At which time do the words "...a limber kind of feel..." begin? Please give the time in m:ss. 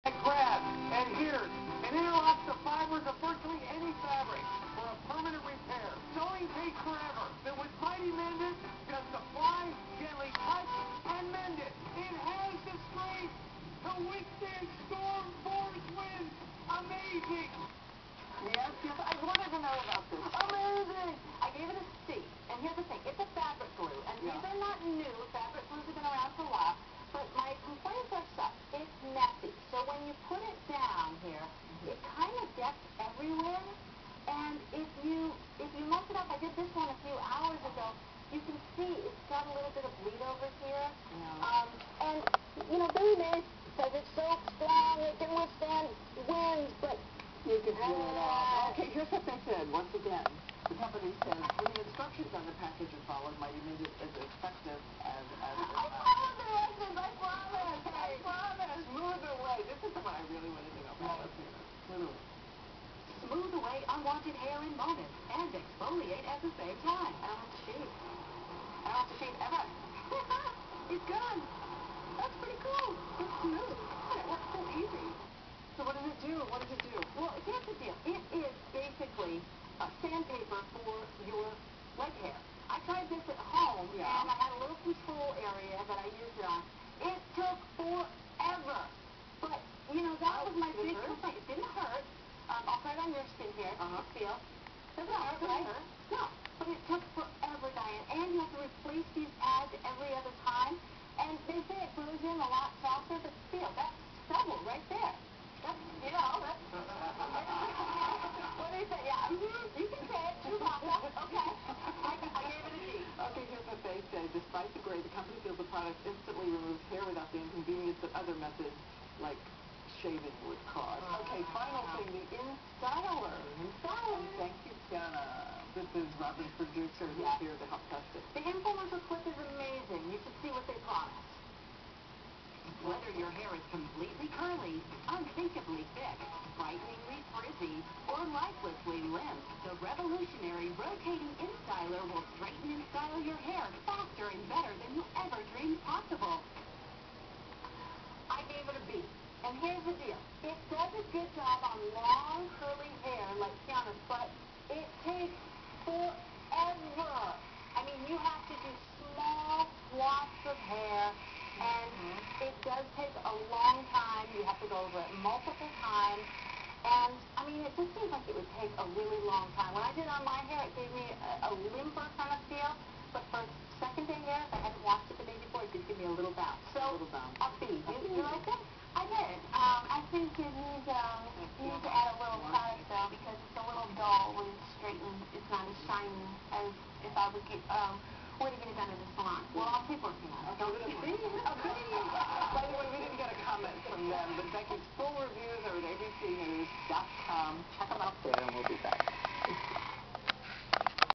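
2:51.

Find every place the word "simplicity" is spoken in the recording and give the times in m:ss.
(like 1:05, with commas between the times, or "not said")
not said.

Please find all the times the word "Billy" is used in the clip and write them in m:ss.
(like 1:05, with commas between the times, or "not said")
0:42.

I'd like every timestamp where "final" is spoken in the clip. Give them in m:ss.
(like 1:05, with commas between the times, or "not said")
2:01.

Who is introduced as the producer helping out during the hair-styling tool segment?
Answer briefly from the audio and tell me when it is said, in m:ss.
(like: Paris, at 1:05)
Robin, at 2:06.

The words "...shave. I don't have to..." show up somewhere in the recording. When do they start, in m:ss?
1:07.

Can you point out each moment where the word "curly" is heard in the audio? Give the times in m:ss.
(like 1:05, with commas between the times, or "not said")
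2:14, 2:32.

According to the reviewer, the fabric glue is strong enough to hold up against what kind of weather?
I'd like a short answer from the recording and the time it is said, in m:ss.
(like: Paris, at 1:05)
storm force winds, at 0:14.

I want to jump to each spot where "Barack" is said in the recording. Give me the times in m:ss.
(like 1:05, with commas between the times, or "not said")
not said.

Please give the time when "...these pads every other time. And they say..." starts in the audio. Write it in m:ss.
1:39.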